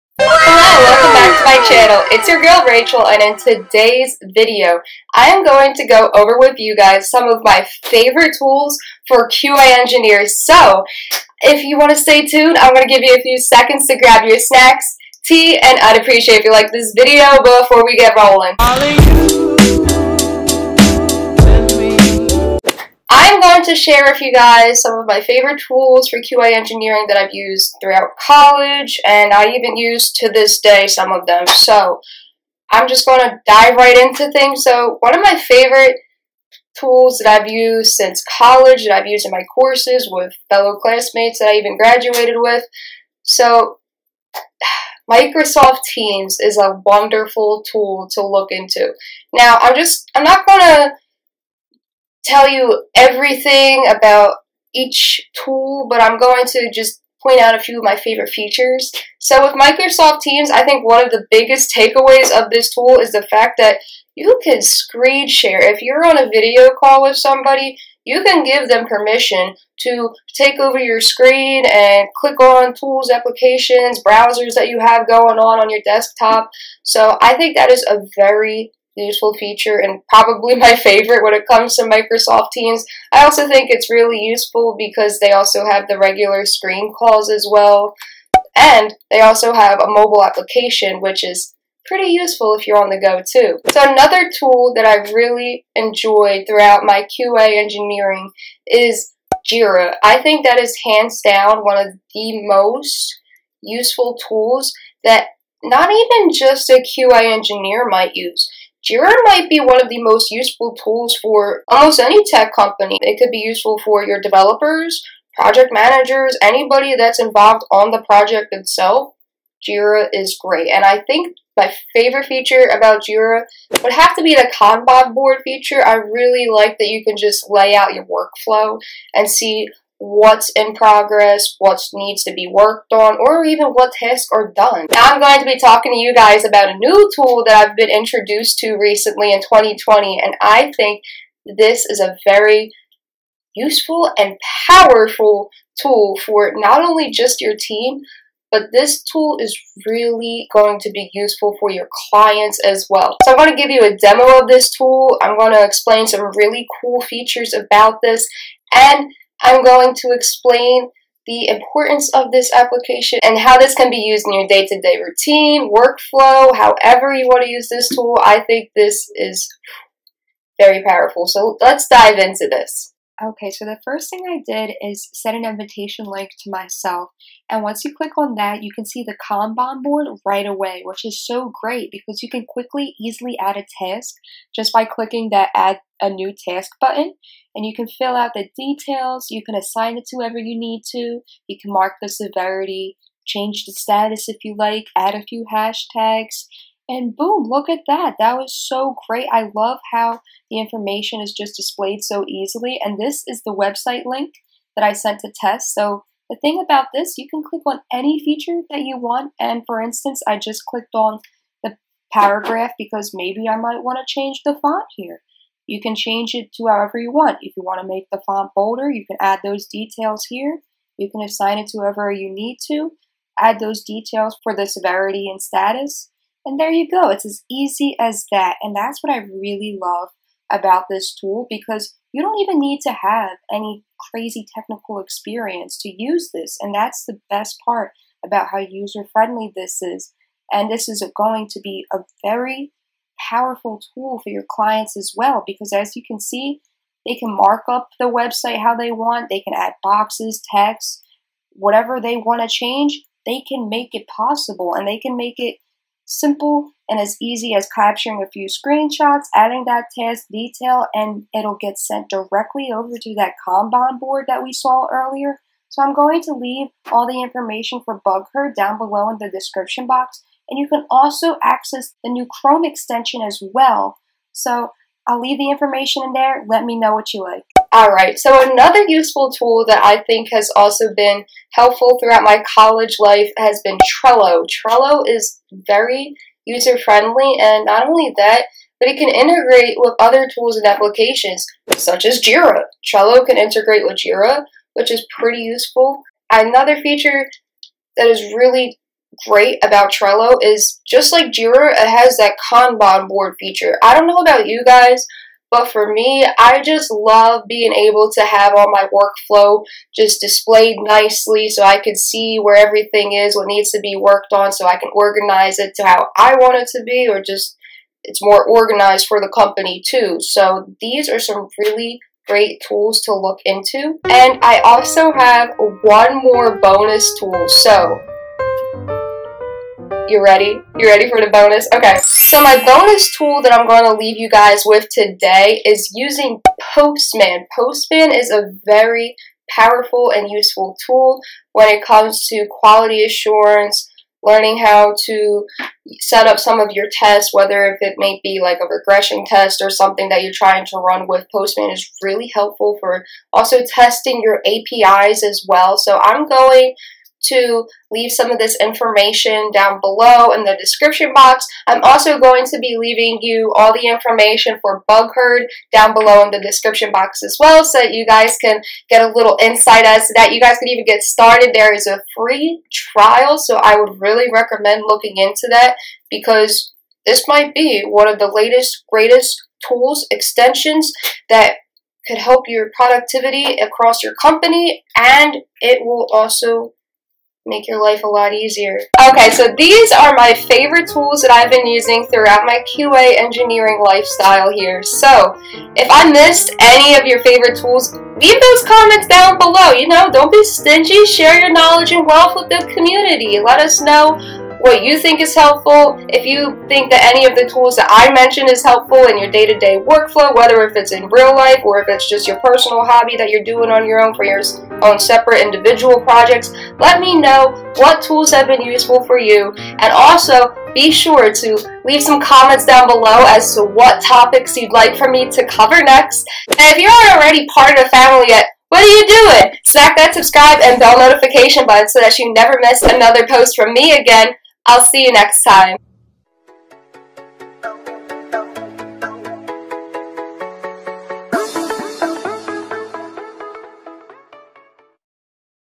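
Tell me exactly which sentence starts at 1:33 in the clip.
So another tool that I really enjoyed throughout my QA engineering is Jira.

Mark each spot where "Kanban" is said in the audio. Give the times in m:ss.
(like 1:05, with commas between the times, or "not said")
2:04, 2:59, 4:23, 5:02.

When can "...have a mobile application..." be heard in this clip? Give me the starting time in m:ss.
1:29.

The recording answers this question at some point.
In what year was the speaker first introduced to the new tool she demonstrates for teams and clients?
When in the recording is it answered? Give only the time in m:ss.
2:19.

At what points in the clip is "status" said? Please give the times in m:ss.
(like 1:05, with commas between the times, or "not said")
3:13, 3:45.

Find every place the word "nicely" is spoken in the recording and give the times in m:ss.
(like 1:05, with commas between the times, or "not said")
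5:10.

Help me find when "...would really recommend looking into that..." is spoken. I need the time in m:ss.
6:13.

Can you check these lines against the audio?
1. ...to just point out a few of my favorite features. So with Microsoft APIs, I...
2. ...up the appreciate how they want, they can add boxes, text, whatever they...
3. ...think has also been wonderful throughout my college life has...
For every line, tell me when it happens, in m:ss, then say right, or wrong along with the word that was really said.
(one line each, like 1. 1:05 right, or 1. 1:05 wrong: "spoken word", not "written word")
1. 0:56 wrong: "Teams", not "APIs"
2. 4:07 wrong: "website", not "appreciate"
3. 4:40 wrong: "helpful", not "wonderful".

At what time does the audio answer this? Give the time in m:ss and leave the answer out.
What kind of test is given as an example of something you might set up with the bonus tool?
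5:48.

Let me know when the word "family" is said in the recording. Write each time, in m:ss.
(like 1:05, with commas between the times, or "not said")
7:07.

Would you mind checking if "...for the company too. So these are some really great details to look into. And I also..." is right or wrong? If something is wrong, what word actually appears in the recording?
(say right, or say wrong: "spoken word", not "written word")
wrong: "tools", not "details".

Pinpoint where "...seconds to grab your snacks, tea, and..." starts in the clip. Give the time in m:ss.
0:13.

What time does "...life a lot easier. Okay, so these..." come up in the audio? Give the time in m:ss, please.
6:27.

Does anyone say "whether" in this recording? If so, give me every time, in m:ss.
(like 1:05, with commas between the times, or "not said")
5:47, 6:50.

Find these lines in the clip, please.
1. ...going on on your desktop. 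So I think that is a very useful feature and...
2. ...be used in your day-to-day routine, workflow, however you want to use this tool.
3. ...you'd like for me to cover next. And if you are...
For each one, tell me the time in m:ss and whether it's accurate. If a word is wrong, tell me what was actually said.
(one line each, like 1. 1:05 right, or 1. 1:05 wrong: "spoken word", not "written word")
1. 1:15 right
2. 2:43 right
3. 7:04 right.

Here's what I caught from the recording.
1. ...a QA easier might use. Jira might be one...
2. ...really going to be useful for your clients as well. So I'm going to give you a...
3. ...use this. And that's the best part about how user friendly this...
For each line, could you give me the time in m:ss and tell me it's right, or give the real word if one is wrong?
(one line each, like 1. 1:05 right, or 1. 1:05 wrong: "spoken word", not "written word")
1. 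1:46 wrong: "engineer", not "easier"
2. 2:29 right
3. 3:56 right.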